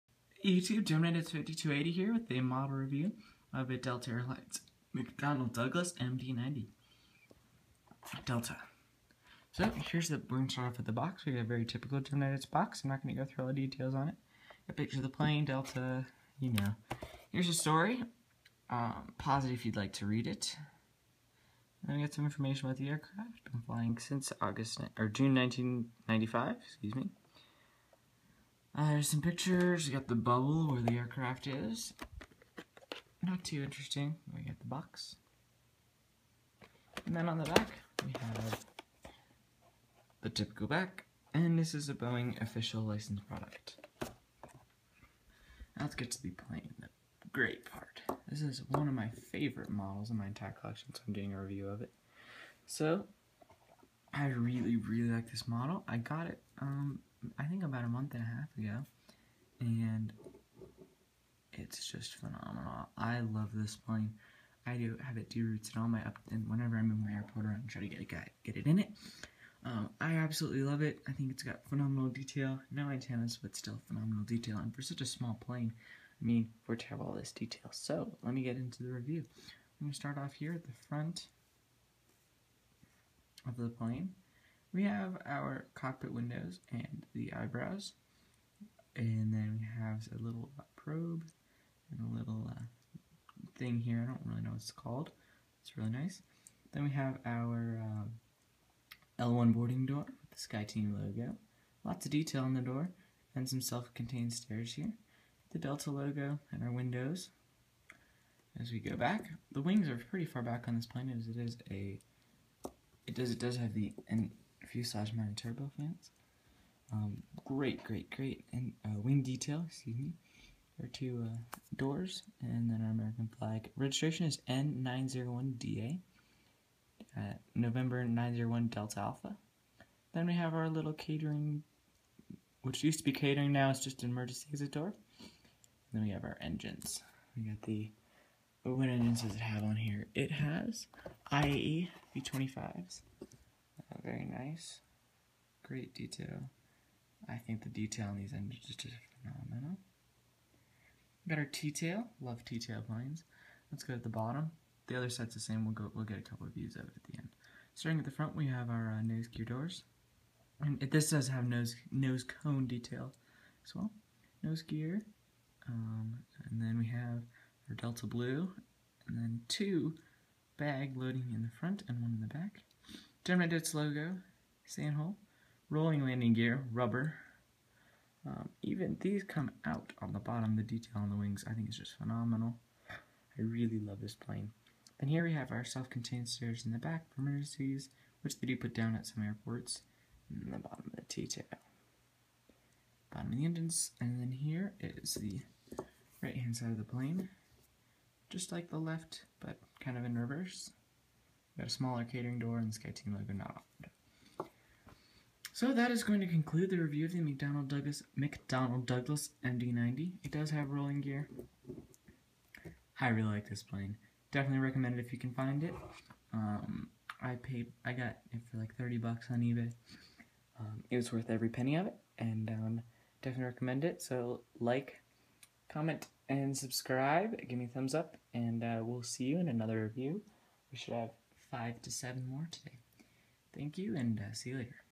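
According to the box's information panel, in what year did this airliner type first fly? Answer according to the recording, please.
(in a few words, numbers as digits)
1995.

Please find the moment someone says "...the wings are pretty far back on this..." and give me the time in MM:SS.
01:49.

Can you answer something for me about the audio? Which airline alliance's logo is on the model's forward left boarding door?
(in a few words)
SkyTeam.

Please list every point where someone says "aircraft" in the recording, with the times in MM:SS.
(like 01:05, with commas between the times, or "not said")
00:22, 00:30.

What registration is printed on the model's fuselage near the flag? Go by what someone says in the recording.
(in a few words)
N901DA.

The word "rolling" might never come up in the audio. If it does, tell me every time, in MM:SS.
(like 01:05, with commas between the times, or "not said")
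02:55, 03:30.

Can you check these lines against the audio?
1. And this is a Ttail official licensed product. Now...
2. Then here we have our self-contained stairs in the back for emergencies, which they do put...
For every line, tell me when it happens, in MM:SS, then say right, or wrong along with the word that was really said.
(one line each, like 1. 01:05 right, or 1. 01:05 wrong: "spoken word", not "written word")
1. 00:41 wrong: "Boeing", not "Ttail"
2. 03:04 right.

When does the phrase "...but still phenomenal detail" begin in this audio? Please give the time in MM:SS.
01:13.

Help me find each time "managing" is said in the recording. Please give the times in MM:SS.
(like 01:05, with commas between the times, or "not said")
not said.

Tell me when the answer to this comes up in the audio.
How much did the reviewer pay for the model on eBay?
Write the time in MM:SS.
03:38.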